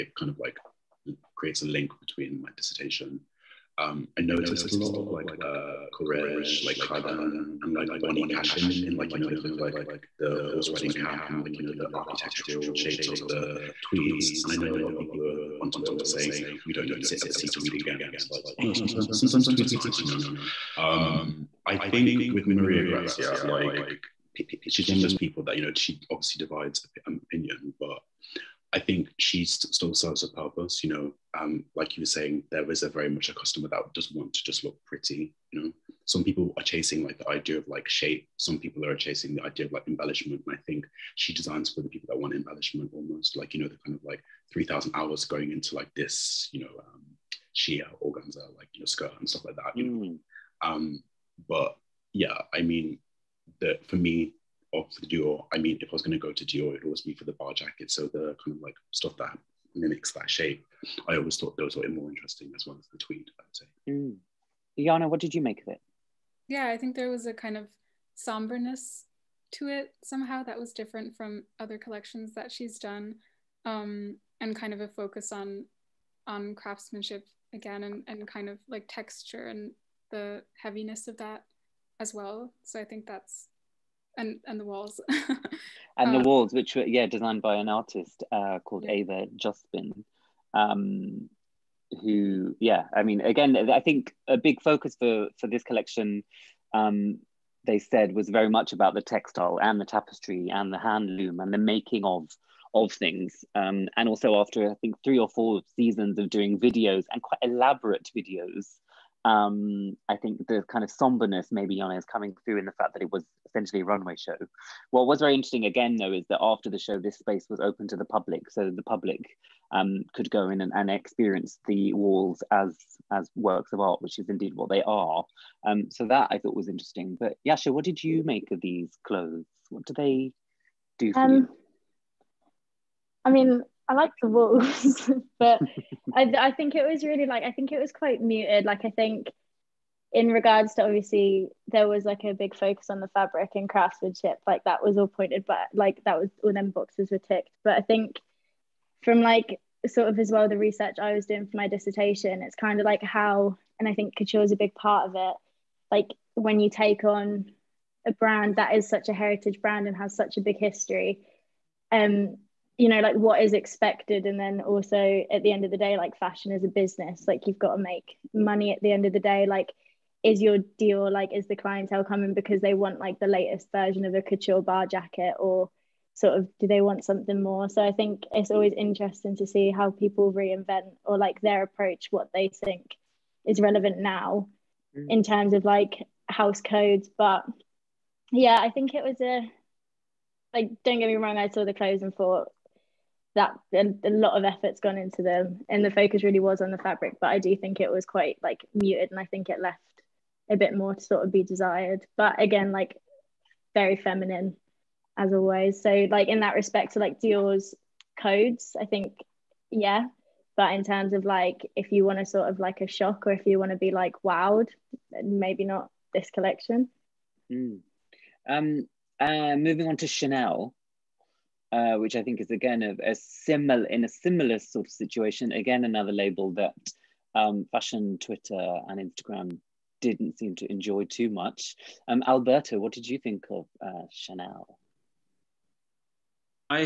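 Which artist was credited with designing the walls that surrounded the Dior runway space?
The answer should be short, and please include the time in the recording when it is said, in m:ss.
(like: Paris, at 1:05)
Eva Jospin, at 1:28.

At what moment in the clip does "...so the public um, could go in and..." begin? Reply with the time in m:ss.
1:58.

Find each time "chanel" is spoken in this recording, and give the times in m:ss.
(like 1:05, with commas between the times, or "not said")
3:40, 3:54.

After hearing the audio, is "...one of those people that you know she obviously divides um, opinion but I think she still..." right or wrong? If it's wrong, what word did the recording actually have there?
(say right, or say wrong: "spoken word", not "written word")
right.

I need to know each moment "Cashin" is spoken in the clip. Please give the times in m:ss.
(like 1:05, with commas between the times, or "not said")
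0:08.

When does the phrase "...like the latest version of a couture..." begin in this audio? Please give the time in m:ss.
2:52.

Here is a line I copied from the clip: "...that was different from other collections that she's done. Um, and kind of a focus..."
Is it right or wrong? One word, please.
right.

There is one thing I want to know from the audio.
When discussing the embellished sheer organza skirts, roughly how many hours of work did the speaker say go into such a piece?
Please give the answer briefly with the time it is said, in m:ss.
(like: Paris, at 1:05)
3000, at 0:44.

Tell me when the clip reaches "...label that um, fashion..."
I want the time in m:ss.
3:46.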